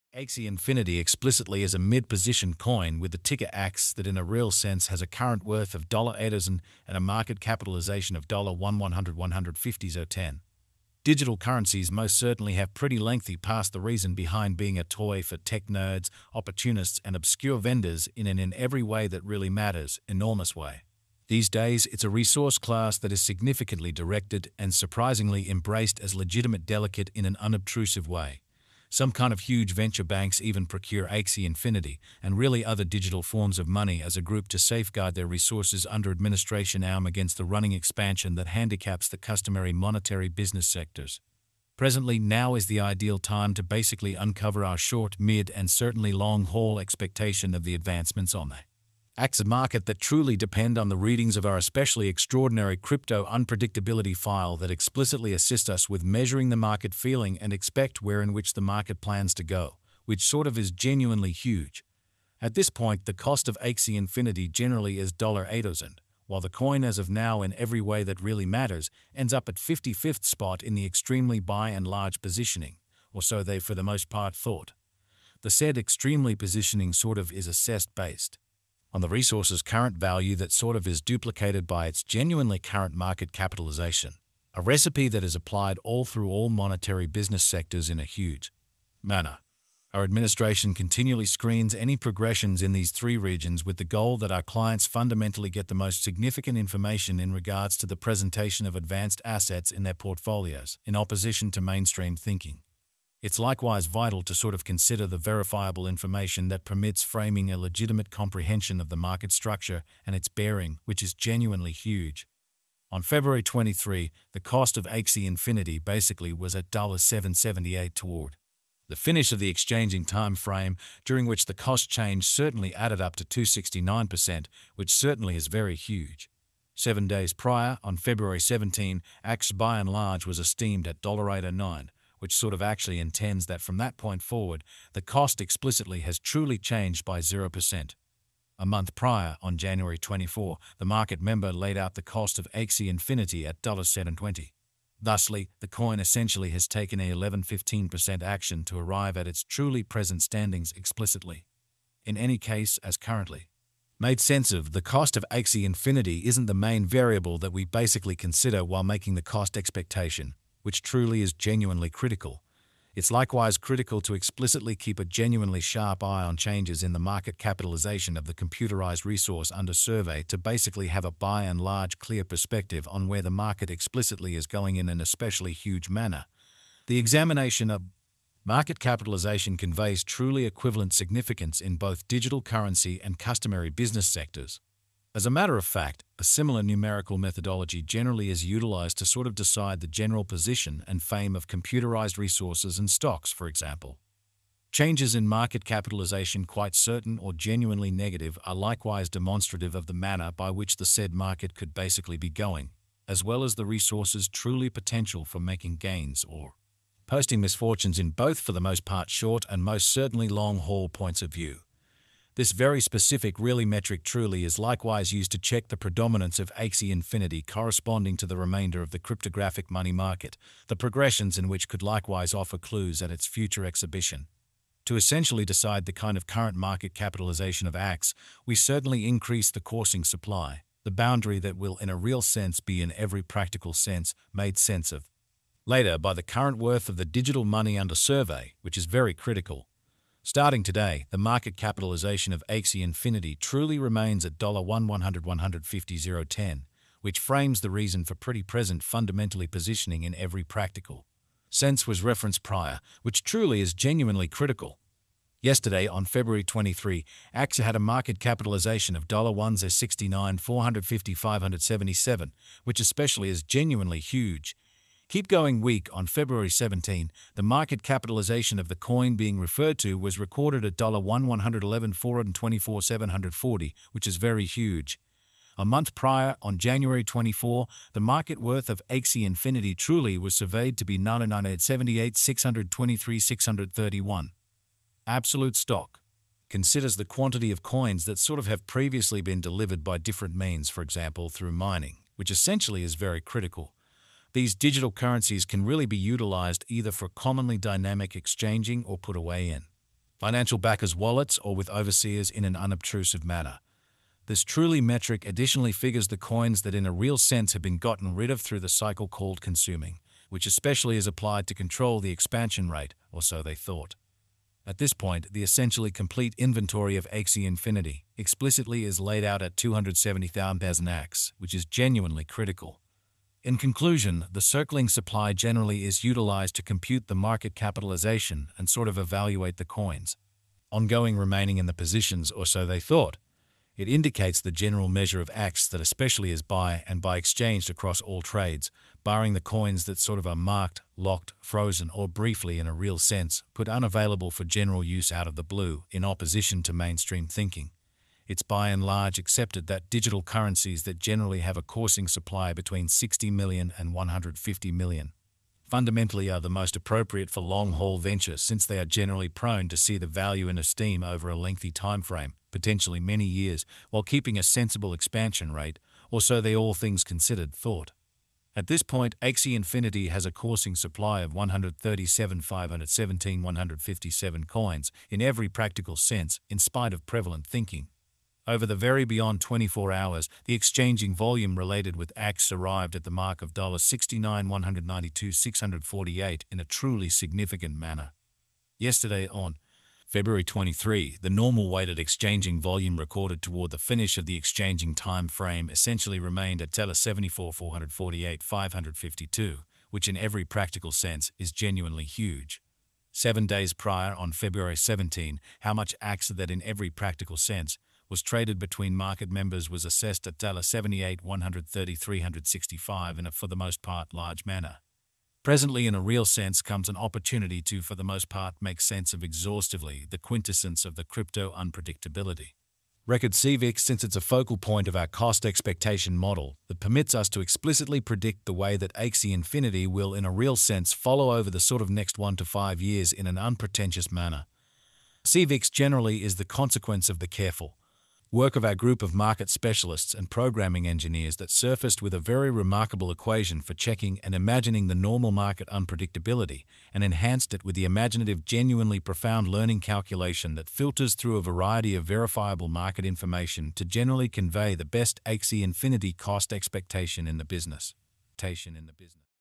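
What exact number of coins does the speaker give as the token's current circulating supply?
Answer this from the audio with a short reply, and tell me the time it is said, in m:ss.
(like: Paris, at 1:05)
137,517,157, at 6:11.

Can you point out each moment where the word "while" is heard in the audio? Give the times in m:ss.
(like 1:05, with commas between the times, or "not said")
1:06, 2:38, 6:03.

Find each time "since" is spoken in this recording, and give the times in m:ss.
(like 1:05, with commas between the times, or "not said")
5:58, 7:03.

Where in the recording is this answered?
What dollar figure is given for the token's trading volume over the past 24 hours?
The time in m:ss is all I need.
6:23.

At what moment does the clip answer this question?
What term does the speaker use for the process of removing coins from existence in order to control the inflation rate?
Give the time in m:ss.
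5:09.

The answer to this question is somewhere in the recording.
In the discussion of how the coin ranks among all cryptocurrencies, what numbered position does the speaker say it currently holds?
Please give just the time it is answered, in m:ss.
1:09.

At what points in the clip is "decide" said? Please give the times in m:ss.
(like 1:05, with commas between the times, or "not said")
3:09, 3:45.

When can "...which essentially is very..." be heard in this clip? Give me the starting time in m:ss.
4:52.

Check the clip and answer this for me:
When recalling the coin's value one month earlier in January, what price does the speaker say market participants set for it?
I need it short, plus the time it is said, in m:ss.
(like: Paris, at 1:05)
$7.20, at 2:23.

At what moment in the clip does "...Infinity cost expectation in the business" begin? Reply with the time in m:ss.
7:35.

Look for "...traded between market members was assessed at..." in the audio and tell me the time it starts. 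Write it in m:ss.
6:48.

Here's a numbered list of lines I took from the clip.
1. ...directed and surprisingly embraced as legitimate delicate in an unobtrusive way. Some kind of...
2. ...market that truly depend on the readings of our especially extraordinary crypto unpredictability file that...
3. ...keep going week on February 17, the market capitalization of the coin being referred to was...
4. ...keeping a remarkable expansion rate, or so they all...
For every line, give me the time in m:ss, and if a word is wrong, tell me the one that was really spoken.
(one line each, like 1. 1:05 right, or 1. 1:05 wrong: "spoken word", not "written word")
1. 0:23 right
2. 0:49 right
3. 4:25 right
4. 6:04 wrong: "sensible", not "remarkable".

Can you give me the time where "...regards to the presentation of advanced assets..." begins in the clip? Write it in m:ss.
1:37.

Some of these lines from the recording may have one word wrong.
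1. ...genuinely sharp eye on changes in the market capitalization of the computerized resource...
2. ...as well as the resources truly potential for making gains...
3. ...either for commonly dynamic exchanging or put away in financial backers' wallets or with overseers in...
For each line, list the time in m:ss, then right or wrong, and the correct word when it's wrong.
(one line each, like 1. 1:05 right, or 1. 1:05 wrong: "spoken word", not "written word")
1. 2:45 right
2. 3:23 right
3. 4:56 right.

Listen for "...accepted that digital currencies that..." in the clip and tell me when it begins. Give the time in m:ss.
5:49.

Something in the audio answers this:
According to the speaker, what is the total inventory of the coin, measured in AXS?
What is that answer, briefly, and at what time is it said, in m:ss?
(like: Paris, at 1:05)
270,000 AXS, at 5:19.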